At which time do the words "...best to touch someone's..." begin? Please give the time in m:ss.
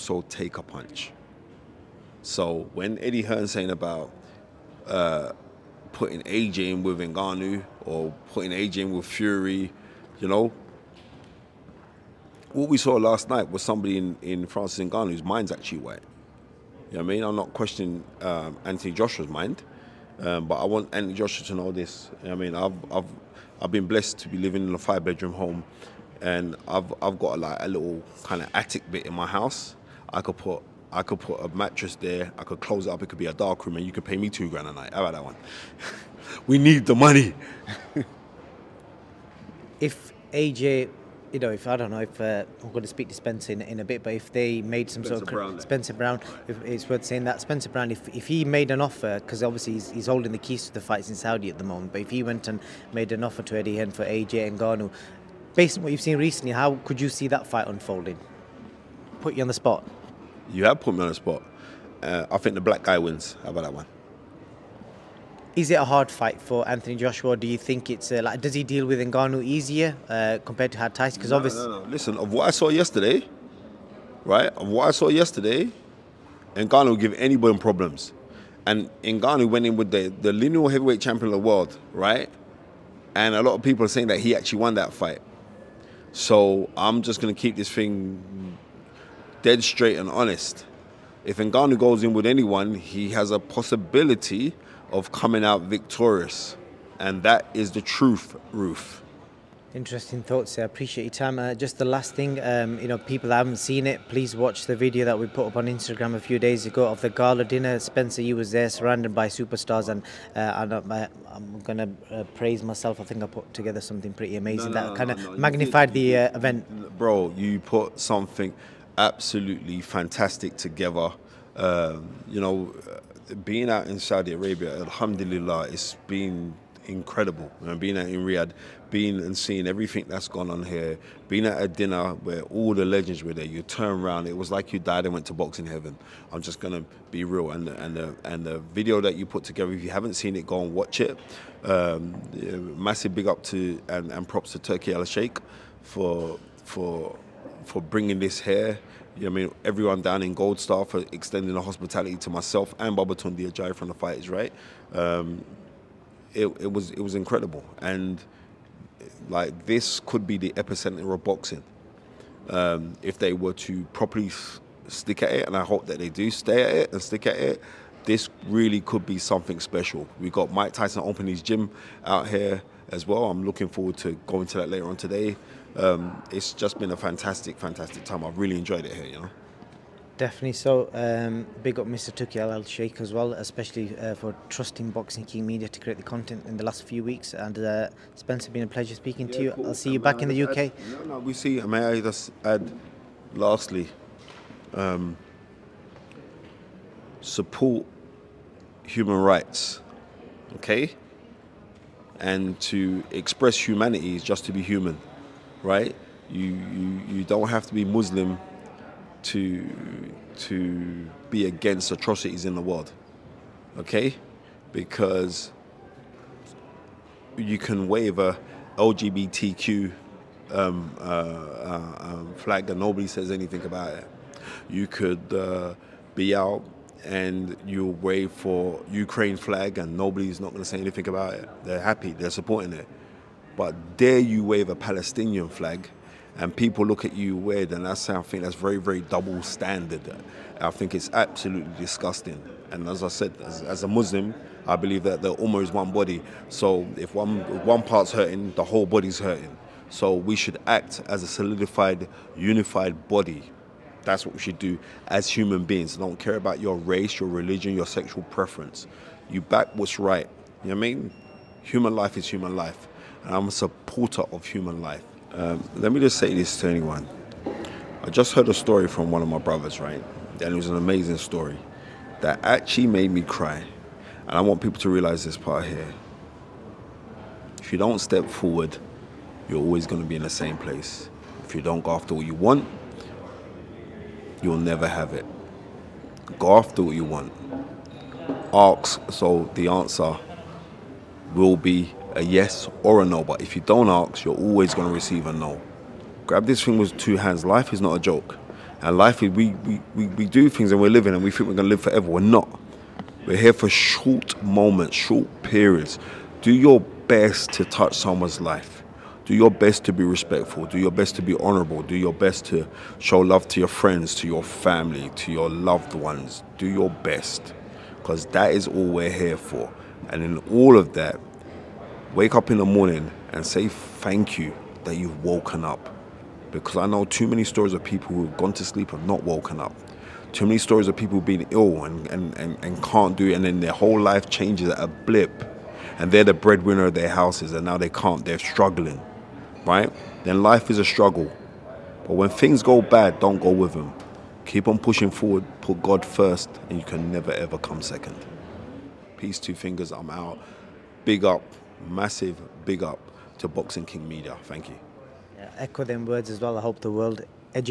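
5:06.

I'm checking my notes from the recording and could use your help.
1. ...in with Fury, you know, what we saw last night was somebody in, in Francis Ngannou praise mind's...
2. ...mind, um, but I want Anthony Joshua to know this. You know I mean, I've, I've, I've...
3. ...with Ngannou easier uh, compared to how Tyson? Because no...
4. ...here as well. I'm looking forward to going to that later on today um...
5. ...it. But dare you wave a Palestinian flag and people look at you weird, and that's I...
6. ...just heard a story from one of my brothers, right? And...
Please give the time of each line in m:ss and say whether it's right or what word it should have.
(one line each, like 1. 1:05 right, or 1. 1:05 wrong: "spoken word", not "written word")
1. 0:08 wrong: "whose", not "praise"
2. 0:19 right
3. 1:08 right
4. 2:52 right
5. 3:52 right
6. 4:28 right.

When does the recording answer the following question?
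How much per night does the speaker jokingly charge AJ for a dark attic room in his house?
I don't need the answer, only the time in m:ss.
0:34.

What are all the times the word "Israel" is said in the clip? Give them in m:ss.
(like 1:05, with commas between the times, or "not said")
not said.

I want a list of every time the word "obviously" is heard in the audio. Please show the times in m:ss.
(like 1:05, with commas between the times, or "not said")
0:49, 1:11.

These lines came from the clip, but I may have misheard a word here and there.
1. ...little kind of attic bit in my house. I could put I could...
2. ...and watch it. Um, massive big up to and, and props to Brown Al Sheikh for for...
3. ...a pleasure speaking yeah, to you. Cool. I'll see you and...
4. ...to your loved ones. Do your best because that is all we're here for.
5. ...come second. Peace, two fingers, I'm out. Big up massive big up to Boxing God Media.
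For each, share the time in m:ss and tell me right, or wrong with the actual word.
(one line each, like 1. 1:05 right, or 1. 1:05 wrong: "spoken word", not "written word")
1. 0:27 right
2. 2:20 wrong: "Turki", not "Brown"
3. 3:08 right
4. 5:15 right
5. 5:47 wrong: "King", not "God".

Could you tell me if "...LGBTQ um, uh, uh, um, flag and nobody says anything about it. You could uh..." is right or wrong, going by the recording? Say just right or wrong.
right.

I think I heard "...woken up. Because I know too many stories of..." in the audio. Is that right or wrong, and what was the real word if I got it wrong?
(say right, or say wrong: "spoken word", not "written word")
right.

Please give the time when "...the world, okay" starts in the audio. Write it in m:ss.
3:32.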